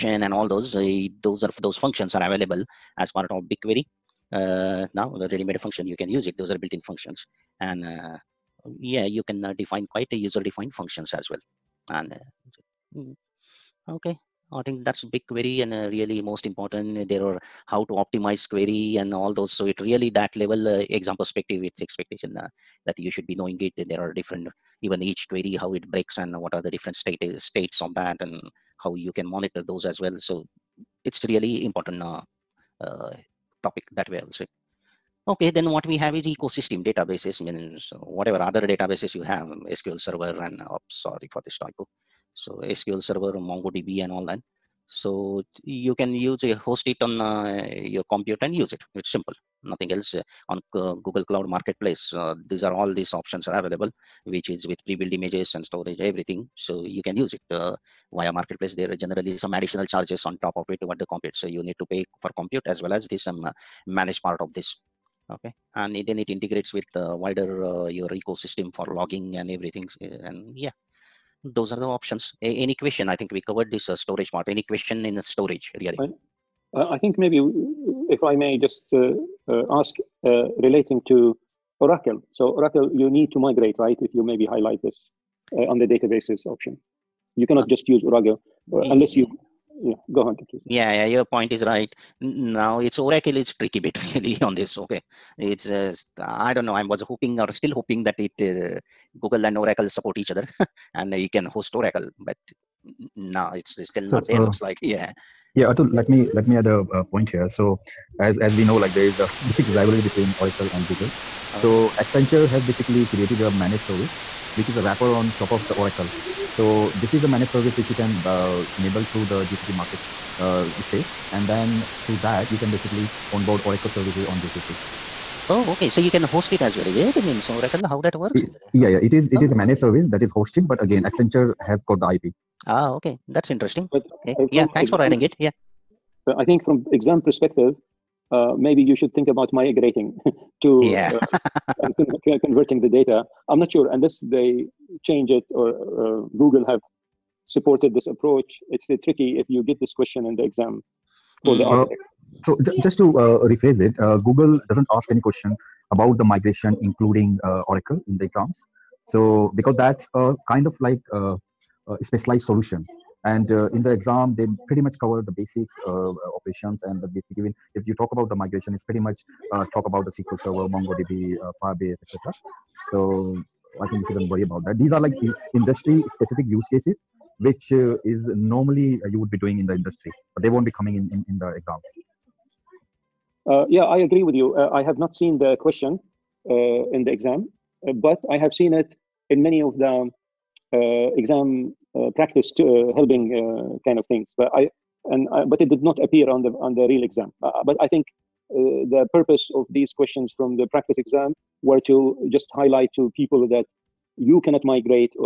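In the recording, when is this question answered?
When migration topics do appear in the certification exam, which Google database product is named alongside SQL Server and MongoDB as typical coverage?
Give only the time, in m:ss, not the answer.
2:51.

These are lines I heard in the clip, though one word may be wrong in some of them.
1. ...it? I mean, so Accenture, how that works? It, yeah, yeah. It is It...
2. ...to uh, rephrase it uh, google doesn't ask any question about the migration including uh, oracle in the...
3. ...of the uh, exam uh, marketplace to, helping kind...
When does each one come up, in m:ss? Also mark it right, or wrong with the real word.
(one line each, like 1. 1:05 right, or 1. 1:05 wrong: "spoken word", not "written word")
1. 2:06 wrong: "Oracle", not "Accenture"
2. 2:32 right
3. 3:09 wrong: "practice", not "marketplace".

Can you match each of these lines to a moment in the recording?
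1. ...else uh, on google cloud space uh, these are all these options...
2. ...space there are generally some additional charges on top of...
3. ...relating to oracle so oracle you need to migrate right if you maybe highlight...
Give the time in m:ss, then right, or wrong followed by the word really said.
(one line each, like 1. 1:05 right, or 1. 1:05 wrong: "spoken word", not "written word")
1. 0:49 wrong: "marketplace", not "space"
2. 0:58 wrong: "marketplace", not "space"
3. 1:20 right.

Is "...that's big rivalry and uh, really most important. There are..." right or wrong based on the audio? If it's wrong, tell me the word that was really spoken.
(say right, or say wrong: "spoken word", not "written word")
wrong: "query", not "rivalry".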